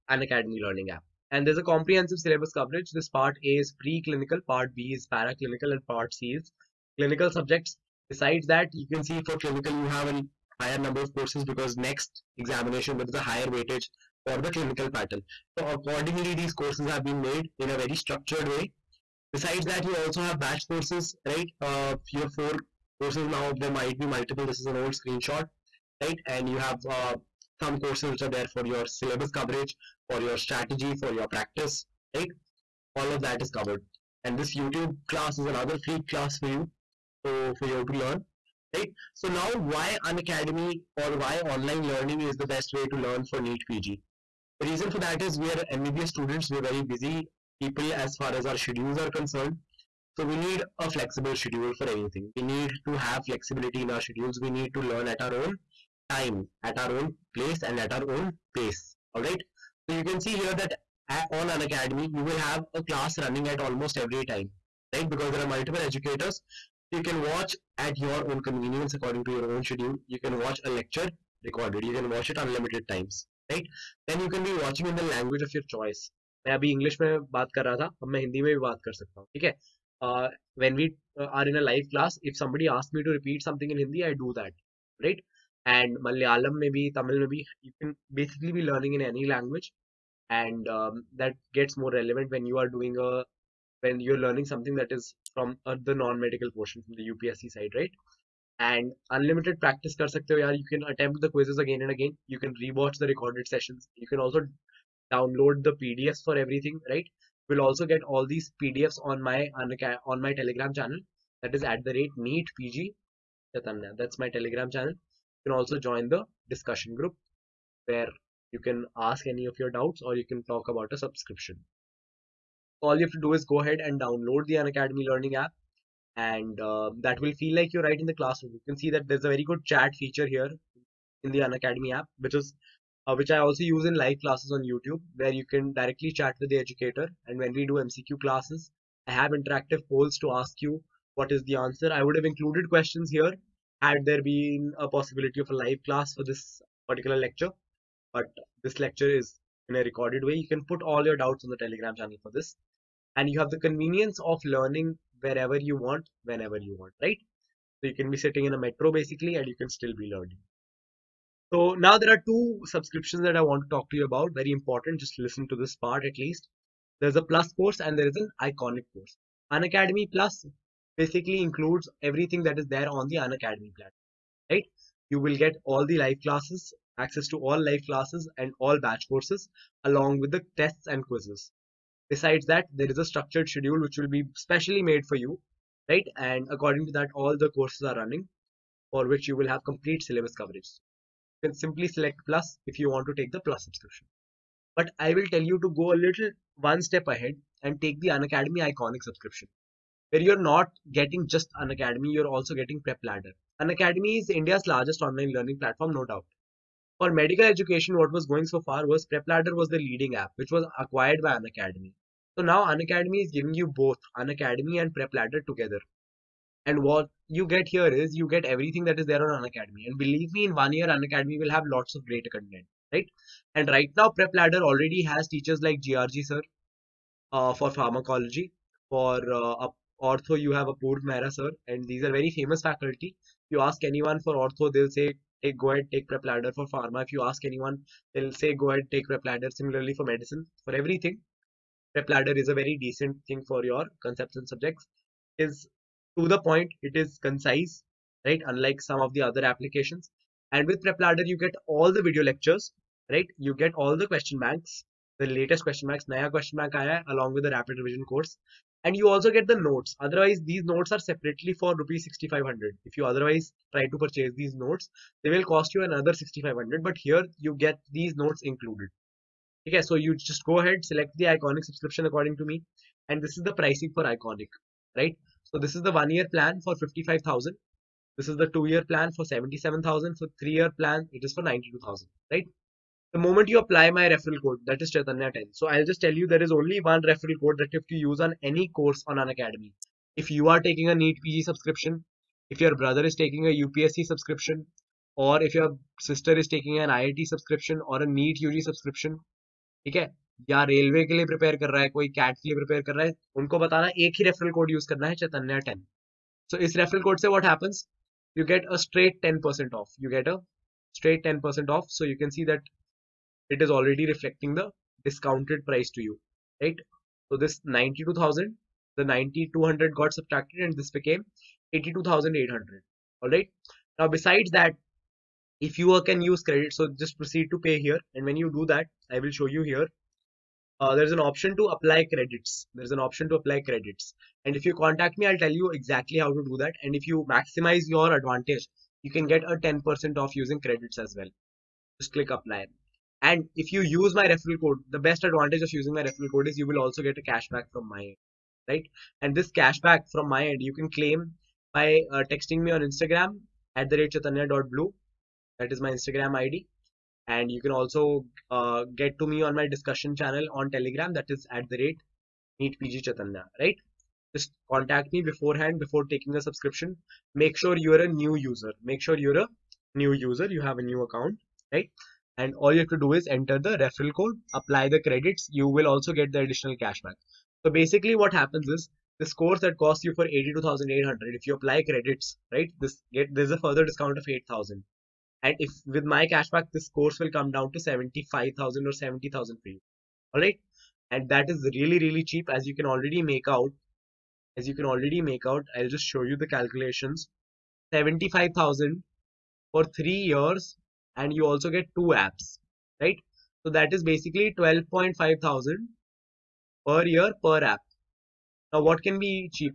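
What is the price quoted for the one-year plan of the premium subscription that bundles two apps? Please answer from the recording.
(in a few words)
55000.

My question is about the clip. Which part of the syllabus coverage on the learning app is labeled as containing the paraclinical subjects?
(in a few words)
Part B.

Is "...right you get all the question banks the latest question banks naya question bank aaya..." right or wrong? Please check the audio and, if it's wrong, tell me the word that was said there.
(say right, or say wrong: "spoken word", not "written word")
right.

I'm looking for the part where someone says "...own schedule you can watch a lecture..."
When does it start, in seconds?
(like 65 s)
69 s.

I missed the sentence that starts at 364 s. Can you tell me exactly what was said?
Just contact me beforehand before taking a subscription.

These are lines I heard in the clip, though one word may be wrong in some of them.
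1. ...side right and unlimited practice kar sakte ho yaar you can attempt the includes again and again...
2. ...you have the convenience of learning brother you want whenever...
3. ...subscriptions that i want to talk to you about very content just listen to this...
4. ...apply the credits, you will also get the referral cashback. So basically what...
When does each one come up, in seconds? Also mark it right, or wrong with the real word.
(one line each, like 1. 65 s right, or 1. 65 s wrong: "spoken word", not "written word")
1. 97 s wrong: "quizzes", not "includes"
2. 153 s wrong: "wherever", not "brother"
3. 162 s wrong: "important", not "content"
4. 374 s wrong: "additional", not "referral".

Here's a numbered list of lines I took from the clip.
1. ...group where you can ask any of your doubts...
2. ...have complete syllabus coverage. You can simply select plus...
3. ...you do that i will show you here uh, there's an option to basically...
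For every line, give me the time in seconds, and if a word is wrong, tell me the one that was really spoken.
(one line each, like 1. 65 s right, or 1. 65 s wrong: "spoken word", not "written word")
1. 116 s right
2. 189 s right
3. 328 s wrong: "apply", not "basically".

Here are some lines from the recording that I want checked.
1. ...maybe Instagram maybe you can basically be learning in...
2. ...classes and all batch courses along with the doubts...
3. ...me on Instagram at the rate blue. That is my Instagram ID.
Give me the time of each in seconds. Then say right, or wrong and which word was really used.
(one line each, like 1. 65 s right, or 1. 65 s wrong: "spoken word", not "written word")
1. 86 s wrong: "Tamil", not "Instagram"
2. 177 s wrong: "tests", not "doubts"
3. 352 s right.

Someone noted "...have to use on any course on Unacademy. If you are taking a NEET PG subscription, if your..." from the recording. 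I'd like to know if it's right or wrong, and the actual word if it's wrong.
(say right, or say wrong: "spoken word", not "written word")
right.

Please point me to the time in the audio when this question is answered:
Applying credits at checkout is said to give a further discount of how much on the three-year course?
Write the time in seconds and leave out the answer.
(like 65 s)
384 s.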